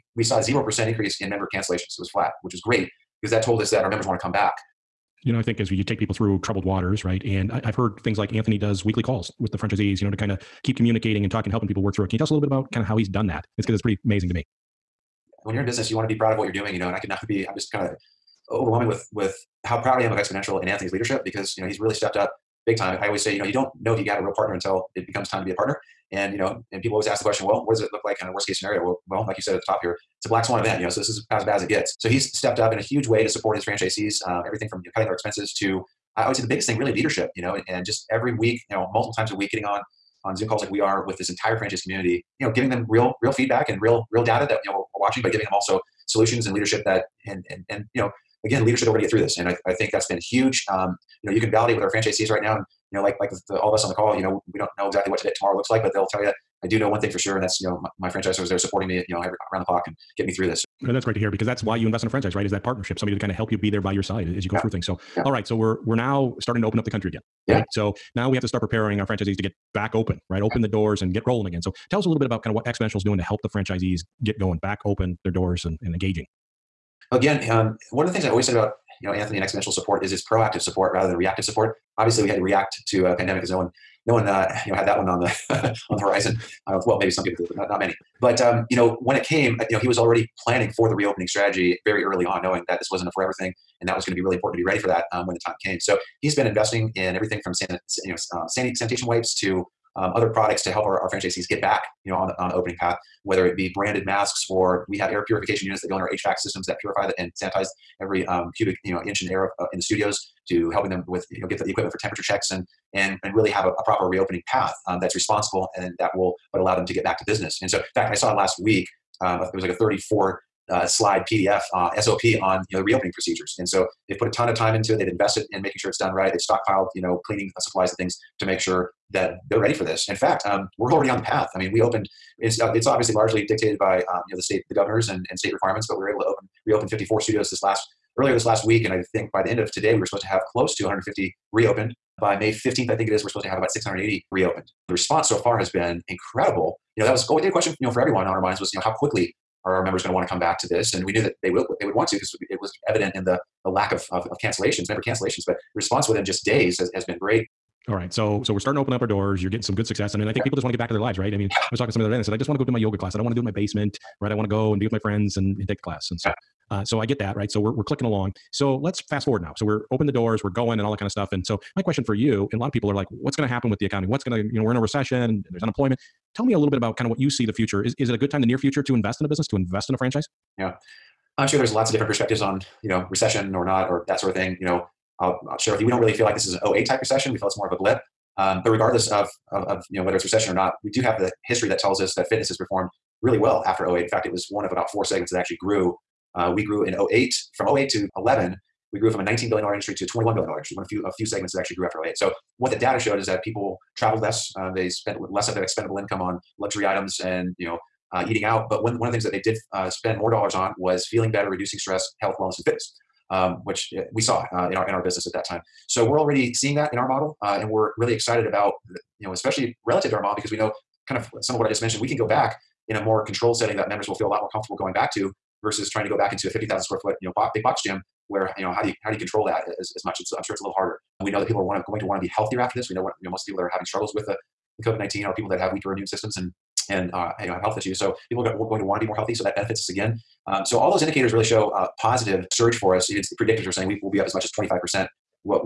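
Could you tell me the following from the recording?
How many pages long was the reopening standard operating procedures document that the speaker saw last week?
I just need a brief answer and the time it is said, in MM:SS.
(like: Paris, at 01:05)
34, at 01:59.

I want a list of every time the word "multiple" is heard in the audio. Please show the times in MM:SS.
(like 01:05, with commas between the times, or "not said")
00:38.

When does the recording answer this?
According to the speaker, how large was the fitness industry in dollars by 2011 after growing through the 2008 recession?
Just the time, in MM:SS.
03:20.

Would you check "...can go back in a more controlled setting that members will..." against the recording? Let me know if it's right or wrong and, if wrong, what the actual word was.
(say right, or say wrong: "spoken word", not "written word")
right.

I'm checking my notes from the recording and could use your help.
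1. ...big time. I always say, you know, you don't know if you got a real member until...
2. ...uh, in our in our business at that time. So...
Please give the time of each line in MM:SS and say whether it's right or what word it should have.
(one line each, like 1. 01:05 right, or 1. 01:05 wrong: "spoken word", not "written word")
1. 00:22 wrong: "partner", not "member"
2. 03:34 right.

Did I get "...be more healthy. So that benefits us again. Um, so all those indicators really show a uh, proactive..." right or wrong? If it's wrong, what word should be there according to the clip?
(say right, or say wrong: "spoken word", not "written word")
wrong: "positive", not "proactive".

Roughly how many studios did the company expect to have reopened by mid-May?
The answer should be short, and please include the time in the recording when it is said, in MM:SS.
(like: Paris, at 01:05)
680, at 02:23.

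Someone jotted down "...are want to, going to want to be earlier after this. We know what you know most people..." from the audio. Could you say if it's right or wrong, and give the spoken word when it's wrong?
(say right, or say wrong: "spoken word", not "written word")
wrong: "healthier", not "earlier".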